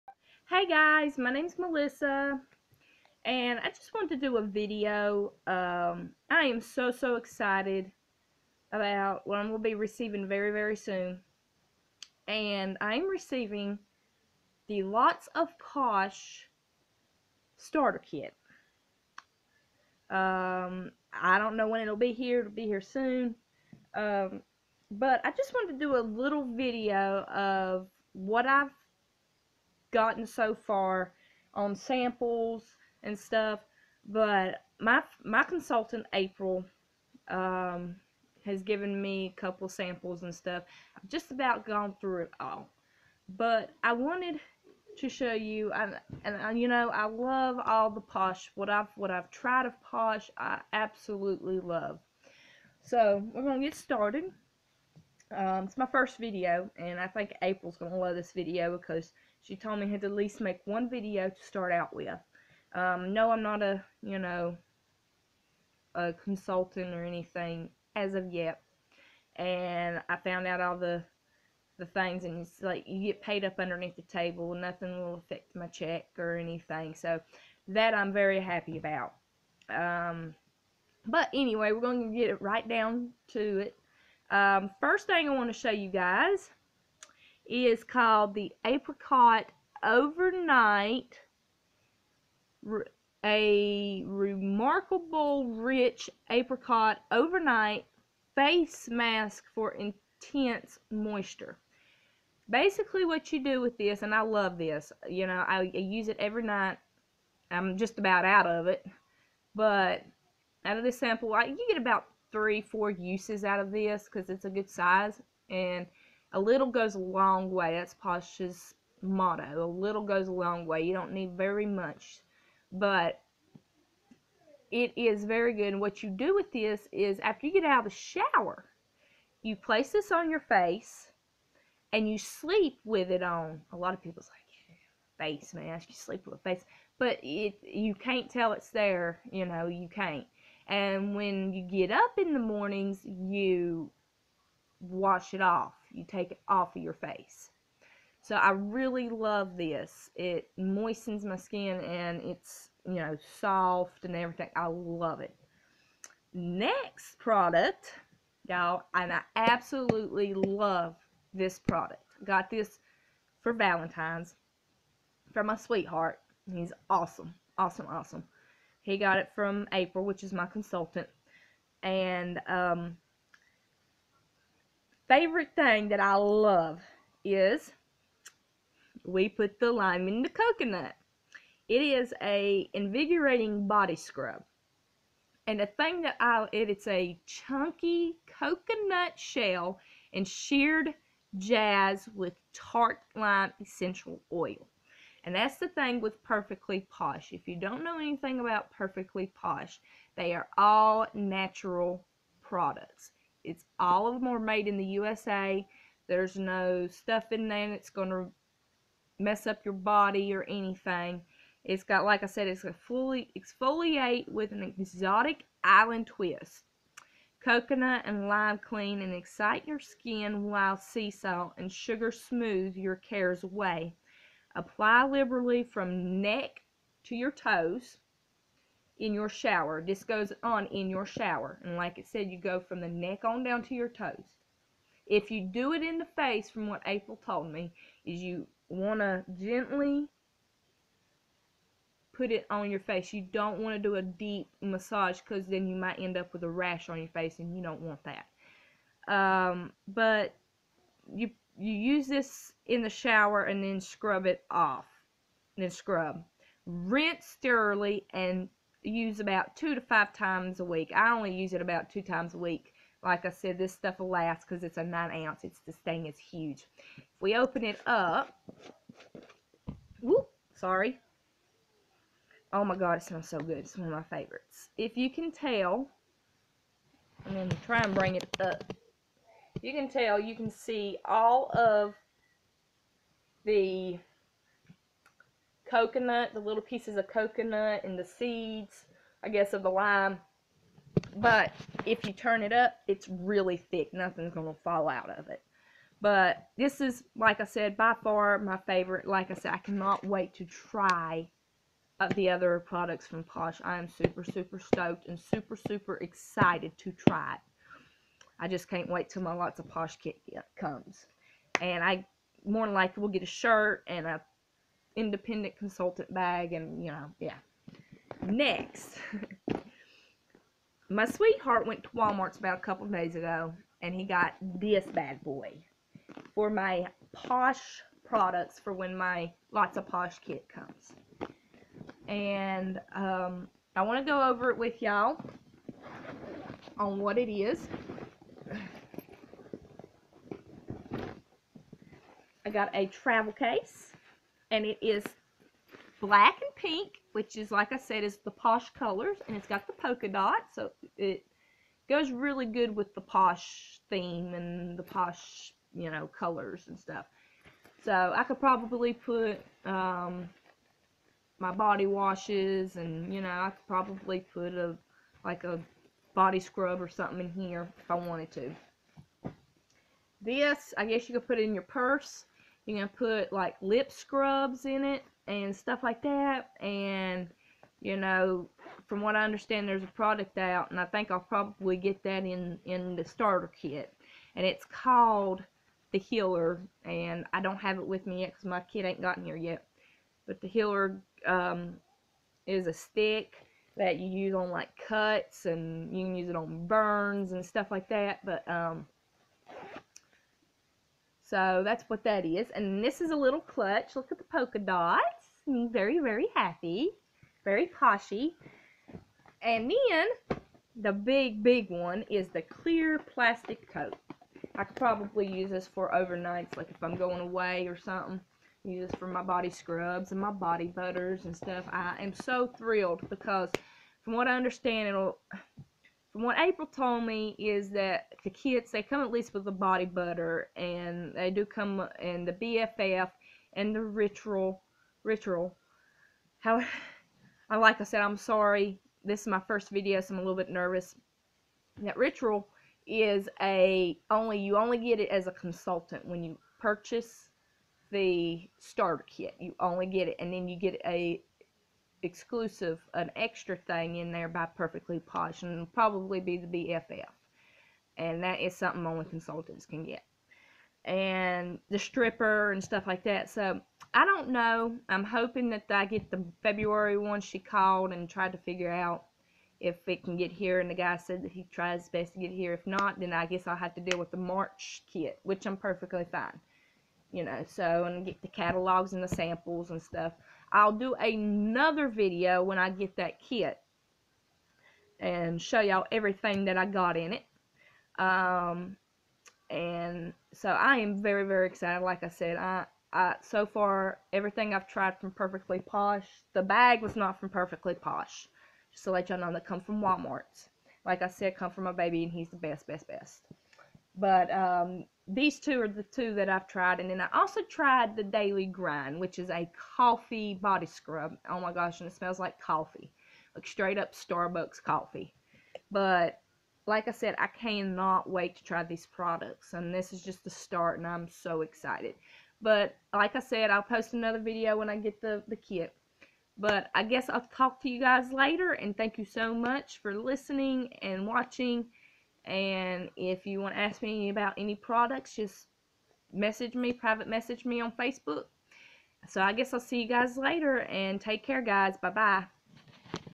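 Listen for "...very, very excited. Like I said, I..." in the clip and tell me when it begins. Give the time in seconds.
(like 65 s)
491 s.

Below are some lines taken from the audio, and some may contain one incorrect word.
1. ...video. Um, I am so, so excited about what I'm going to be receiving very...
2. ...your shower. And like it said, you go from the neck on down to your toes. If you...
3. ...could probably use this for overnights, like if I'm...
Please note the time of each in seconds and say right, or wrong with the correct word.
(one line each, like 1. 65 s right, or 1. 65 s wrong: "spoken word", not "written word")
1. 4 s right
2. 230 s right
3. 414 s right.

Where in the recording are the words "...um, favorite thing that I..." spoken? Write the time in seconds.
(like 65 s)
172 s.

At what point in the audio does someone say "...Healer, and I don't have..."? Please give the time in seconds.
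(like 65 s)
385 s.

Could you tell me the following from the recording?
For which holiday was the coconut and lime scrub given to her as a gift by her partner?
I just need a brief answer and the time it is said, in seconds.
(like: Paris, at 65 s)
Valentine's, at 163 s.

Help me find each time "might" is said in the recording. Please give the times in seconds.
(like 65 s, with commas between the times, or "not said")
245 s.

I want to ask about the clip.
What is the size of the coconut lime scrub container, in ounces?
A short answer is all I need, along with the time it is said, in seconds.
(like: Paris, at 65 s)
9, at 264 s.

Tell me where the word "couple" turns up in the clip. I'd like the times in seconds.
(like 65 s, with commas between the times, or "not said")
39 s, 322 s.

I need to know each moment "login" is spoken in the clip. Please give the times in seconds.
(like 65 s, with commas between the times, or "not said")
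not said.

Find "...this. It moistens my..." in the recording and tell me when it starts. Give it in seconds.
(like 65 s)
149 s.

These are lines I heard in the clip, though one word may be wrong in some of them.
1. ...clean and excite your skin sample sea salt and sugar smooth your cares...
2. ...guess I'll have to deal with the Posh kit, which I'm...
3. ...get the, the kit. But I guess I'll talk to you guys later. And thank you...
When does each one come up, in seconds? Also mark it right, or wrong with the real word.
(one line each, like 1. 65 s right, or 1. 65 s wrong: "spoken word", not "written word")
1. 218 s wrong: "while", not "sample"
2. 473 s wrong: "March", not "Posh"
3. 524 s right.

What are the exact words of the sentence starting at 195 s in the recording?
And that's the thing with Perfectly Posh.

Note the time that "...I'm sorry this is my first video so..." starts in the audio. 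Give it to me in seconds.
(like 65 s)
438 s.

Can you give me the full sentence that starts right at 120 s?
You don't need very much, but it is very good.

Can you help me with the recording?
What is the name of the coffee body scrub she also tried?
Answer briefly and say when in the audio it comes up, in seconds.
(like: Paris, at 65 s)
Daily Grind, at 508 s.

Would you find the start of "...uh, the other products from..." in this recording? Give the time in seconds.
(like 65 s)
302 s.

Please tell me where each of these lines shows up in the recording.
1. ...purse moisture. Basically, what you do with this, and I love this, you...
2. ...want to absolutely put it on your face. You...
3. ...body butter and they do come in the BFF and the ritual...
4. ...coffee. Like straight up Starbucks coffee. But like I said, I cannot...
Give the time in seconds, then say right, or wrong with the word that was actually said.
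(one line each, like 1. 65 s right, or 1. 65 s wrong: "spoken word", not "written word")
1. 99 s wrong: "intense", not "purse"
2. 238 s wrong: "gently", not "absolutely"
3. 429 s right
4. 512 s right.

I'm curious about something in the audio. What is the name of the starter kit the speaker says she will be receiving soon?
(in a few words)
Lots of Posh Starter Kit.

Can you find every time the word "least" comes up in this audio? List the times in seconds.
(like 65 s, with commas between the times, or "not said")
60 s, 429 s.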